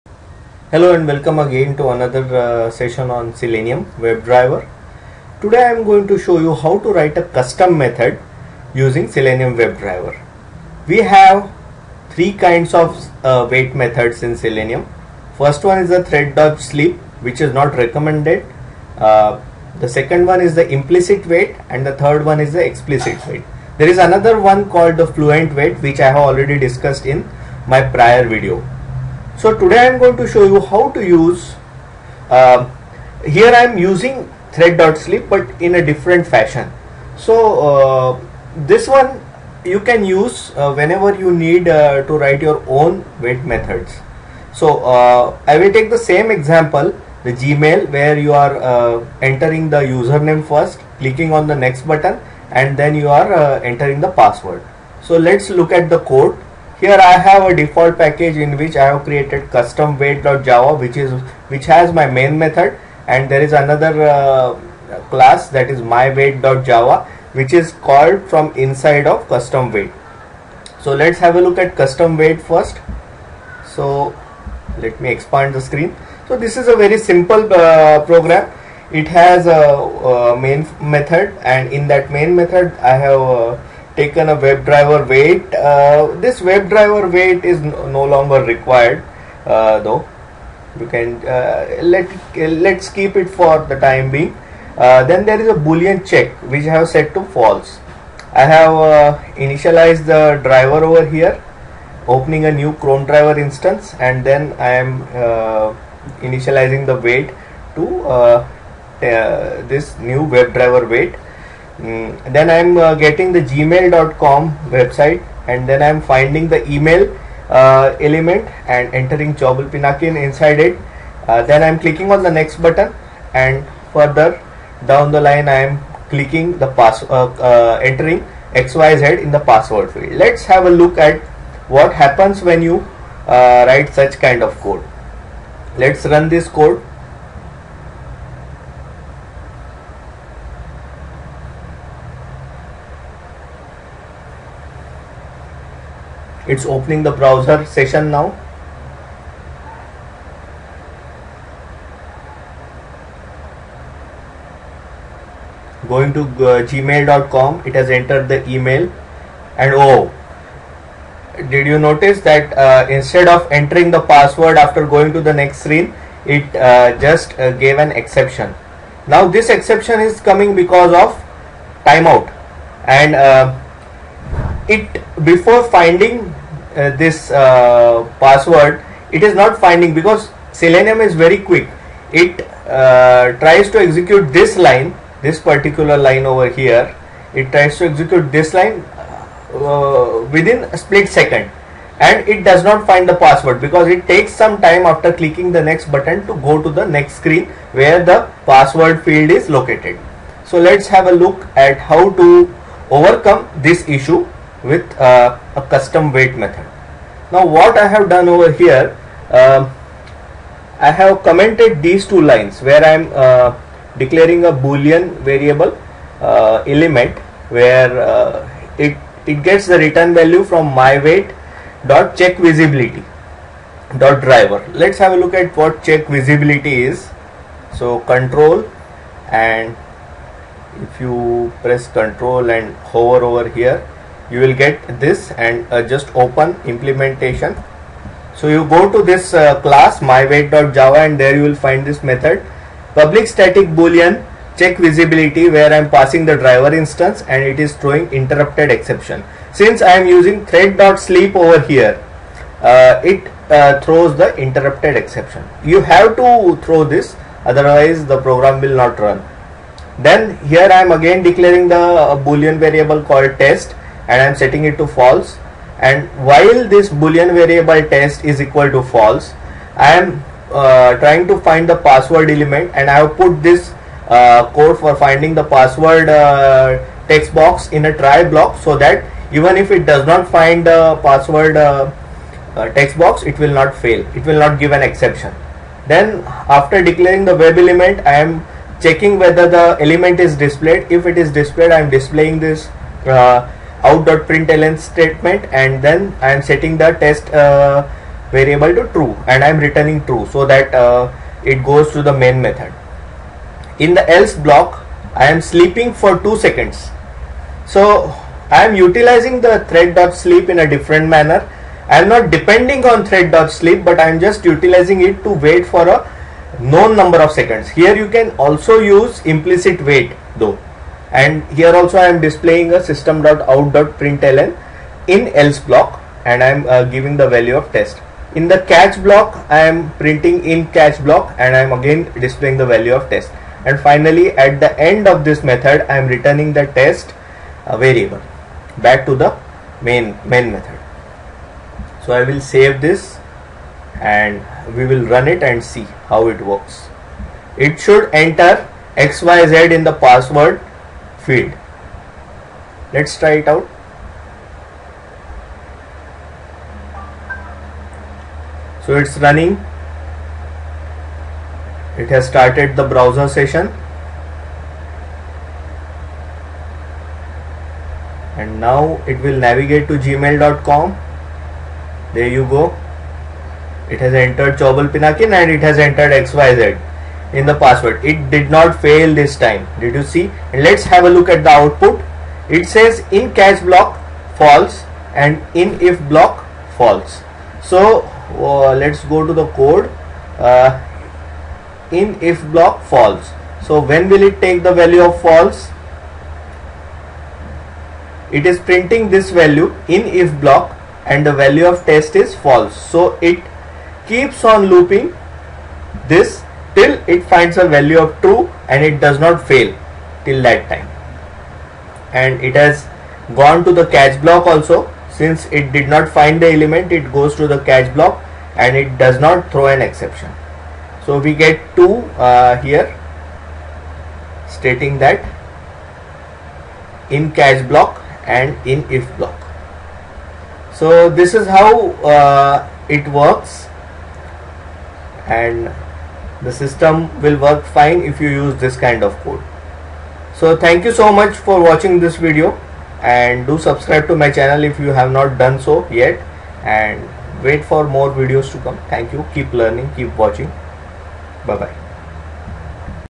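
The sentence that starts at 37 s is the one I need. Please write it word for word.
So uh, this one you can use uh, whenever you need uh, to write your own wait methods.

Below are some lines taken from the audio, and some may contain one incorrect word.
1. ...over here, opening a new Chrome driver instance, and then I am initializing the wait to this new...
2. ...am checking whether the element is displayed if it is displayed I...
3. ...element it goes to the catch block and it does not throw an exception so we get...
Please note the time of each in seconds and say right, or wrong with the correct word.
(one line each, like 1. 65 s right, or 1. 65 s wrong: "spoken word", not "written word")
1. 100 s right
2. 288 s right
3. 416 s right.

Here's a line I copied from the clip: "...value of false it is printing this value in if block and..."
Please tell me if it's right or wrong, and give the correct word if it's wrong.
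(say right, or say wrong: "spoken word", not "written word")
right.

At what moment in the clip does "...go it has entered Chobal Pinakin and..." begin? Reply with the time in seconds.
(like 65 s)
372 s.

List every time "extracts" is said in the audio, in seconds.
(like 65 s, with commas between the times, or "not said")
not said.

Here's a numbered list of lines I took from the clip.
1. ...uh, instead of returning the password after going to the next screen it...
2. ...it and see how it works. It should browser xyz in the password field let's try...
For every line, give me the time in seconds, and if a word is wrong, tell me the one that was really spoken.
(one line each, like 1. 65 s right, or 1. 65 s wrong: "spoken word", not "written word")
1. 162 s wrong: "entering", not "returning"
2. 345 s wrong: "enter", not "browser".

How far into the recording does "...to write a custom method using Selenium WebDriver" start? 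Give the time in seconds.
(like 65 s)
6 s.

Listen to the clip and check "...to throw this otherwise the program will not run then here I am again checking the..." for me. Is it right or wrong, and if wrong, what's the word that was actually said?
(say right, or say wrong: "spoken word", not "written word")
wrong: "declaring", not "checking".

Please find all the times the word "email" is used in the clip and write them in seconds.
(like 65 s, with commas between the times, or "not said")
116 s, 158 s.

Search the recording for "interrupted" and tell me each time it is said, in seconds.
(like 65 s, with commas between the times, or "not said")
248 s, 254 s.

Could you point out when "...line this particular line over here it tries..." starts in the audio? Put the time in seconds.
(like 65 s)
184 s.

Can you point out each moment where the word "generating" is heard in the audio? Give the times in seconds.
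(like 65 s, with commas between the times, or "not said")
not said.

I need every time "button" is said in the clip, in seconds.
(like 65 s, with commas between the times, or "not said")
51 s, 122 s, 195 s.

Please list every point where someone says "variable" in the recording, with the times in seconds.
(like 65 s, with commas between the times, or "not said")
215 s, 262 s, 267 s, 298 s, 337 s.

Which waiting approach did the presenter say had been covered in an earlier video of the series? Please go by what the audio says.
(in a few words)
fluent wait.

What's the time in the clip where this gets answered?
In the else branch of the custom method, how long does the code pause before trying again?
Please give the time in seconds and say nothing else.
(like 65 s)
306 s.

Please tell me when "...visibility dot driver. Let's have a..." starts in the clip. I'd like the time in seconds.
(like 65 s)
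222 s.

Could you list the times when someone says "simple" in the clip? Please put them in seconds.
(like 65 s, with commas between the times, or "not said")
76 s.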